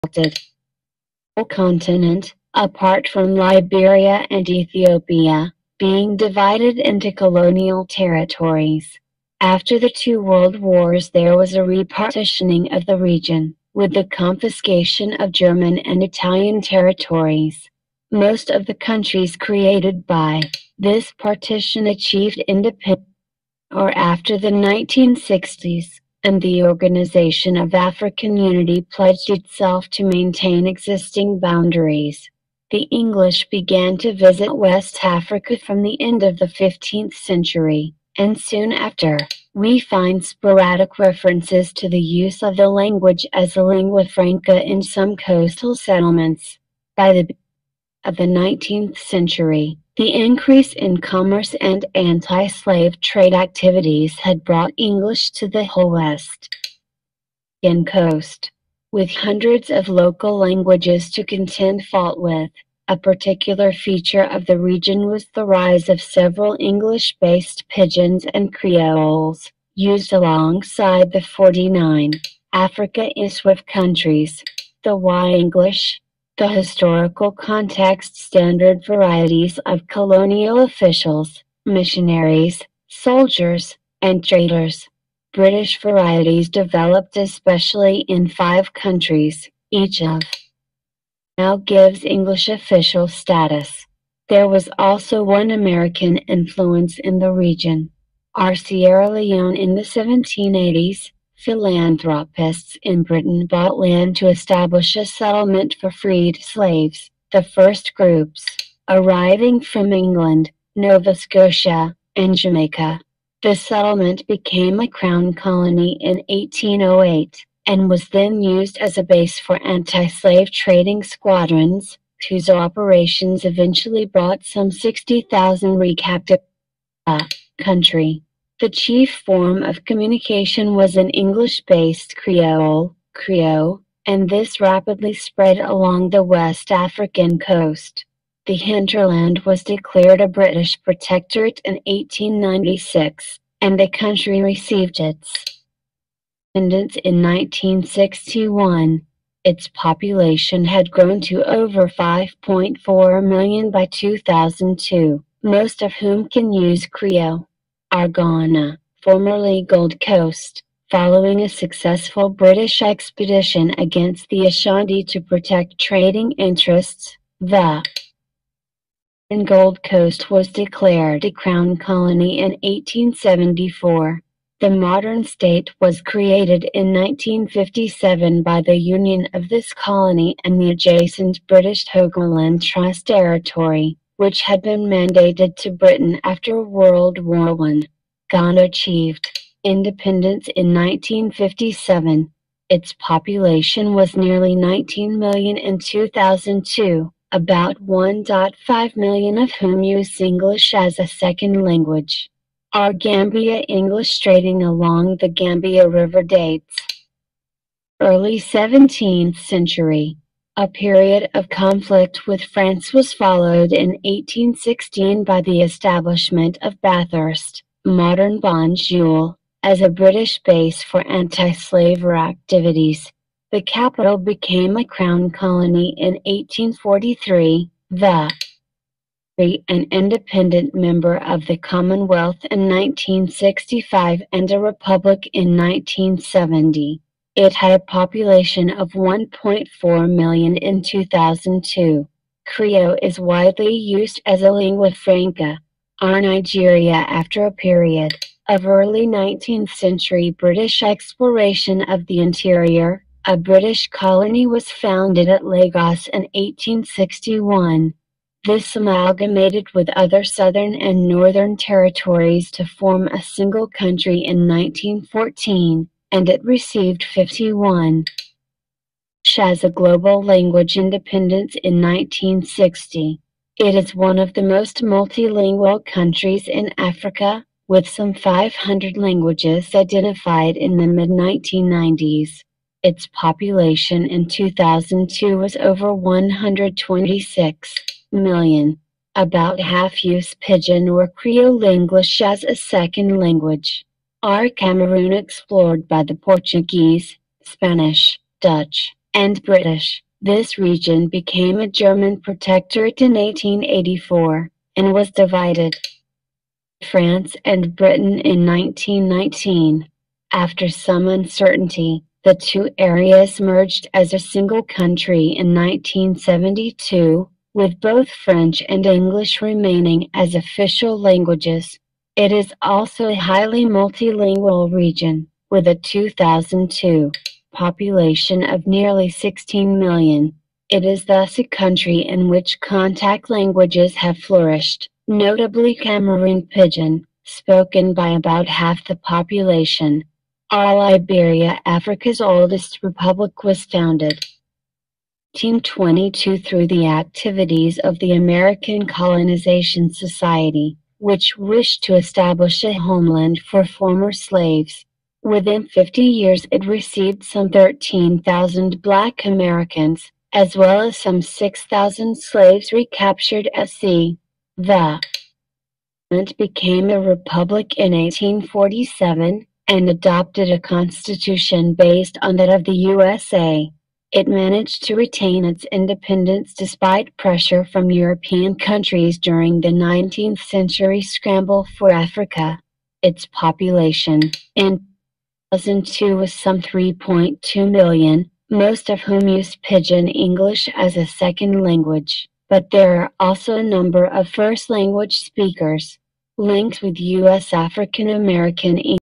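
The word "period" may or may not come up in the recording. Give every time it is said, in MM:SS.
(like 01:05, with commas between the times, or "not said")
03:30, 04:07.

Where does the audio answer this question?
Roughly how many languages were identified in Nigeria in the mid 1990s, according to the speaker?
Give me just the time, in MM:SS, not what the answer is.
04:38.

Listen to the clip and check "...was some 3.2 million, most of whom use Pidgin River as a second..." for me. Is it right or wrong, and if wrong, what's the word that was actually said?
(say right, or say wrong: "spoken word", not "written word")
wrong: "English", not "River".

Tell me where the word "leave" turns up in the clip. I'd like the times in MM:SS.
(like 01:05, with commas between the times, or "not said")
not said.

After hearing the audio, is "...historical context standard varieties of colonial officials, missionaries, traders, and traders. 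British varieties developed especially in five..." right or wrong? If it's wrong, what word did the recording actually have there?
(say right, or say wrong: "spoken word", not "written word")
wrong: "soldiers", not "traders".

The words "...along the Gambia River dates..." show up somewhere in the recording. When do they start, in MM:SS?
03:24.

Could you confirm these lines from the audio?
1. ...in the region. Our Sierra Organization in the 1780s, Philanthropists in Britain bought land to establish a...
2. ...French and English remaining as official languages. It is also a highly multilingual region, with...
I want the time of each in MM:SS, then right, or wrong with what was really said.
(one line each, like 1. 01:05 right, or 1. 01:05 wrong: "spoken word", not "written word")
1. 01:36 wrong: "Leone", not "Organization"
2. 05:18 right.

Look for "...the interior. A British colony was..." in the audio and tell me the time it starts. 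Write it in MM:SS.
04:12.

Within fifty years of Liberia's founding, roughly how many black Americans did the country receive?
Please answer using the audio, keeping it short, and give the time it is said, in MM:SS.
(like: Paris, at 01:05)
13,000, at 05:57.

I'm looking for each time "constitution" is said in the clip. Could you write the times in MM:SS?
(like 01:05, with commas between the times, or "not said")
06:10.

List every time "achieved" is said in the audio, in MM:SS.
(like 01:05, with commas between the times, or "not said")
00:21, 03:08.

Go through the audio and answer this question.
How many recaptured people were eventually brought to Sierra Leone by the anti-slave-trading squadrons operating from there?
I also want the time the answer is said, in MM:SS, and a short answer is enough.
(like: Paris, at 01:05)
60,000, at 02:04.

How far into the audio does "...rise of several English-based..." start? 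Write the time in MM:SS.
01:05.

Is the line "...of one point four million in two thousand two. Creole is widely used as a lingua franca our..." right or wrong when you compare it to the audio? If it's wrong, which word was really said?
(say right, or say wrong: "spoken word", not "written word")
right.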